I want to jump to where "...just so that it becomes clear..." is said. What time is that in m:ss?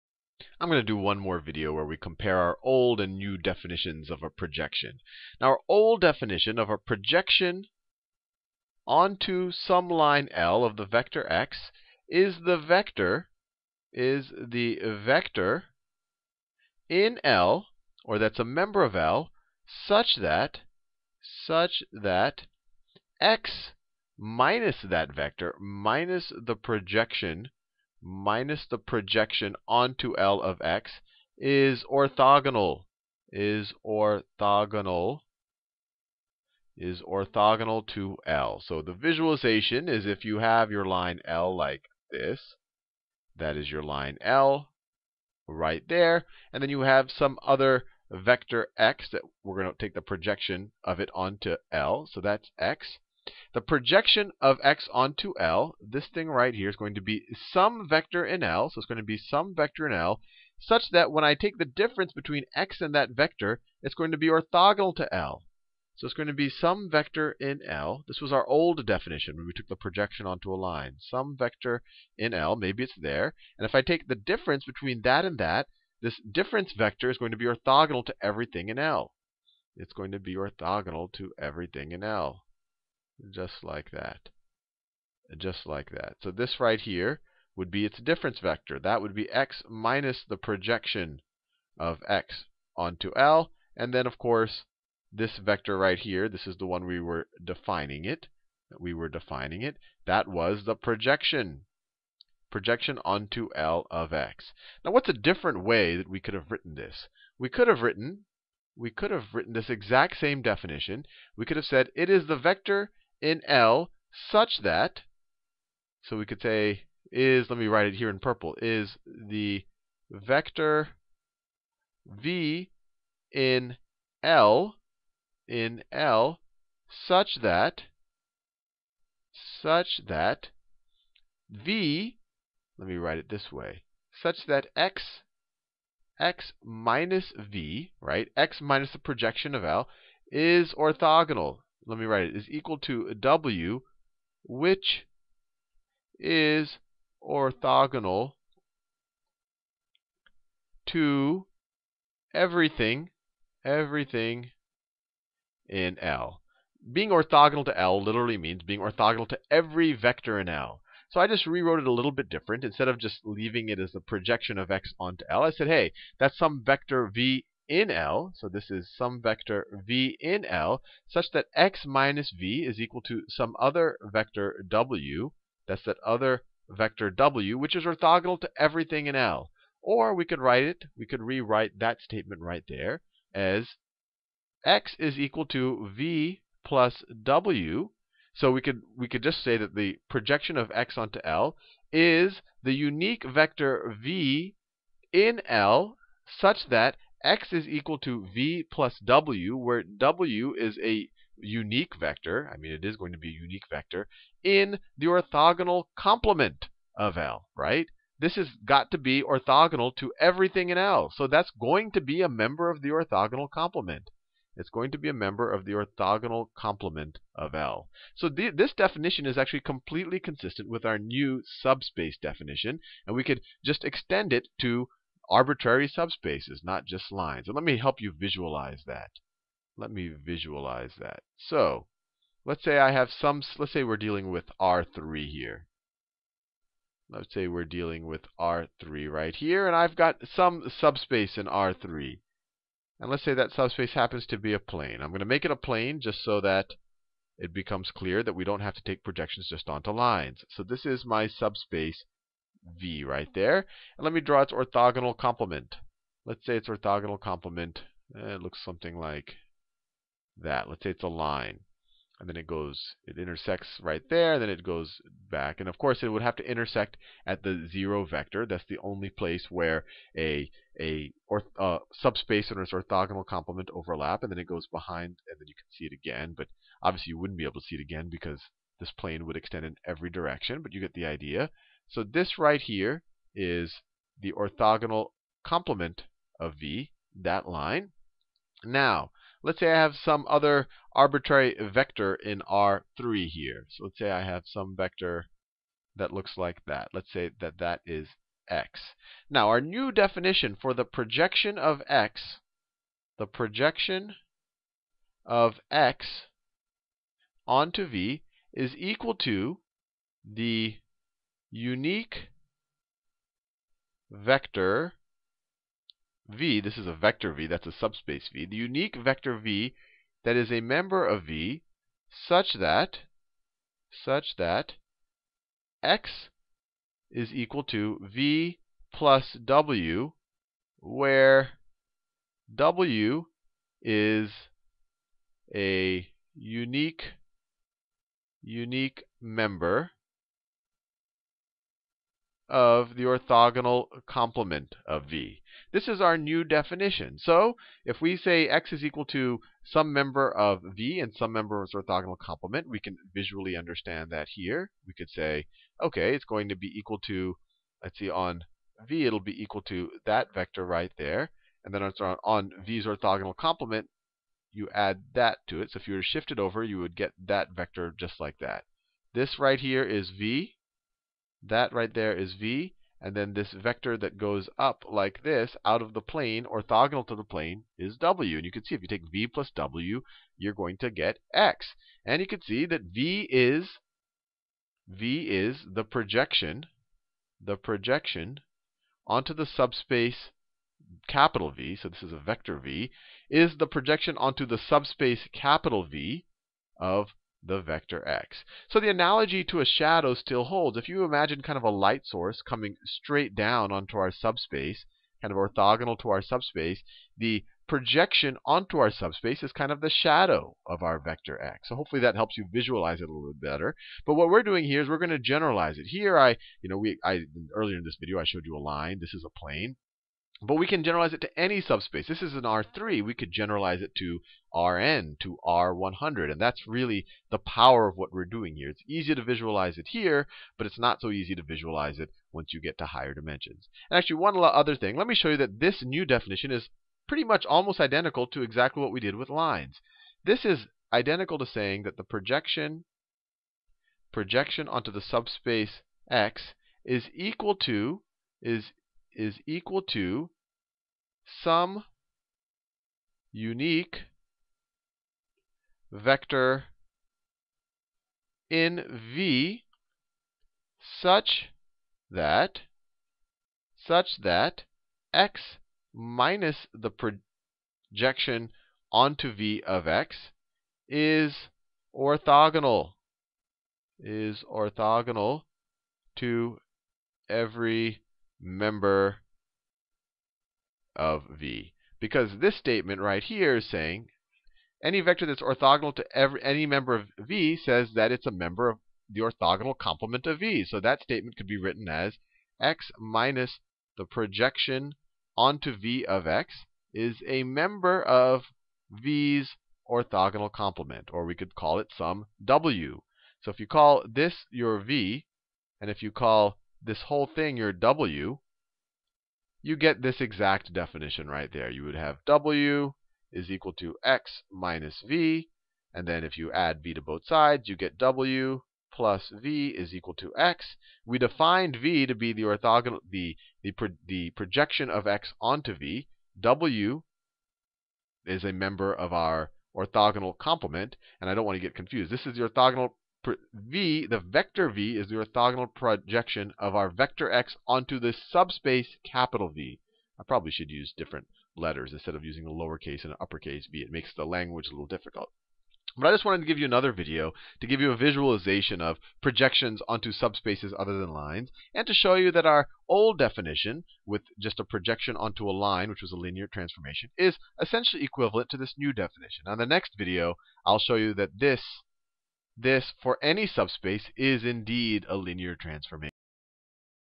4:05.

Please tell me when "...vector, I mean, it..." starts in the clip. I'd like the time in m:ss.
3:21.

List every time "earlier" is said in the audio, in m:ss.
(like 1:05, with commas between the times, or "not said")
6:57.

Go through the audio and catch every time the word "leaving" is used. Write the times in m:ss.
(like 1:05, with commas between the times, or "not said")
2:43.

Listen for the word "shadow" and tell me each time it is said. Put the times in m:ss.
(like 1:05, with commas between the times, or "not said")
6:39, 6:49.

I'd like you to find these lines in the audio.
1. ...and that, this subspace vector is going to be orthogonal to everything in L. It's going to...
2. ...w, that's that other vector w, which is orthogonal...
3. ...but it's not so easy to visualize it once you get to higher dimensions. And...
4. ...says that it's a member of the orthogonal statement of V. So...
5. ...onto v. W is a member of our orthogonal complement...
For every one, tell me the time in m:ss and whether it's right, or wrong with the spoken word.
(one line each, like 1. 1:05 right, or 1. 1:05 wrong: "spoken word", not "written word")
1. 1:15 wrong: "difference", not "subspace"
2. 2:54 right
3. 7:10 right
4. 8:07 wrong: "complement", not "statement"
5. 8:45 right.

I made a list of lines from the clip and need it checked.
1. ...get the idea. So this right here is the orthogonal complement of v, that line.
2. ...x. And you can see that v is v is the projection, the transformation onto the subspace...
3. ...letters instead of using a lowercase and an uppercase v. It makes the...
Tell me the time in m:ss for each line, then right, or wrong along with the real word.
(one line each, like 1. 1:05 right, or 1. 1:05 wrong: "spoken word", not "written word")
1. 4:40 right
2. 6:21 wrong: "projection", not "transformation"
3. 9:01 right.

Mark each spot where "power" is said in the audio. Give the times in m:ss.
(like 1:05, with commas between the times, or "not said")
7:07.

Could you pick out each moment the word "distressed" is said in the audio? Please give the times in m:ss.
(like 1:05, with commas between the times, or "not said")
not said.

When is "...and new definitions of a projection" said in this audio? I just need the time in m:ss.
0:03.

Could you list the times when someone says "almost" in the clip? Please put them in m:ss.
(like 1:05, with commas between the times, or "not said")
7:17.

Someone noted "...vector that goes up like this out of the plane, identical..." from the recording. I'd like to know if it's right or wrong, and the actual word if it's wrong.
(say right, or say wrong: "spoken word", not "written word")
wrong: "orthogonal", not "identical".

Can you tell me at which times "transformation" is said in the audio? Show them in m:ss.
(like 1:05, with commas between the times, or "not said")
9:16, 9:25.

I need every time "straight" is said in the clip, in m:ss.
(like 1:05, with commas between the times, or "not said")
6:42.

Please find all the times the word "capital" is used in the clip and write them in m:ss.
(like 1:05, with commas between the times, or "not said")
6:31, 6:35, 8:59.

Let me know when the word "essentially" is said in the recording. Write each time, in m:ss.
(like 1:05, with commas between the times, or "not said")
9:17.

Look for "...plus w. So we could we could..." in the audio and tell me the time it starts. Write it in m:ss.
3:06.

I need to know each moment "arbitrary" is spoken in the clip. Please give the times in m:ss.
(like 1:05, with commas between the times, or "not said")
3:45, 4:50.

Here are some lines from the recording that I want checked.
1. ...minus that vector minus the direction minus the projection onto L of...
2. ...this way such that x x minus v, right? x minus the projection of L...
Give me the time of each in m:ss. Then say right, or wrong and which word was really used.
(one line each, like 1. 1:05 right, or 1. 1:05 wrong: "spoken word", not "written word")
1. 0:24 wrong: "projection", not "direction"
2. 2:13 right.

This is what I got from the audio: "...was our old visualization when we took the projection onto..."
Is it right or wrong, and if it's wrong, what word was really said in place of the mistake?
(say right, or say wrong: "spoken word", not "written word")
wrong: "definition", not "visualization".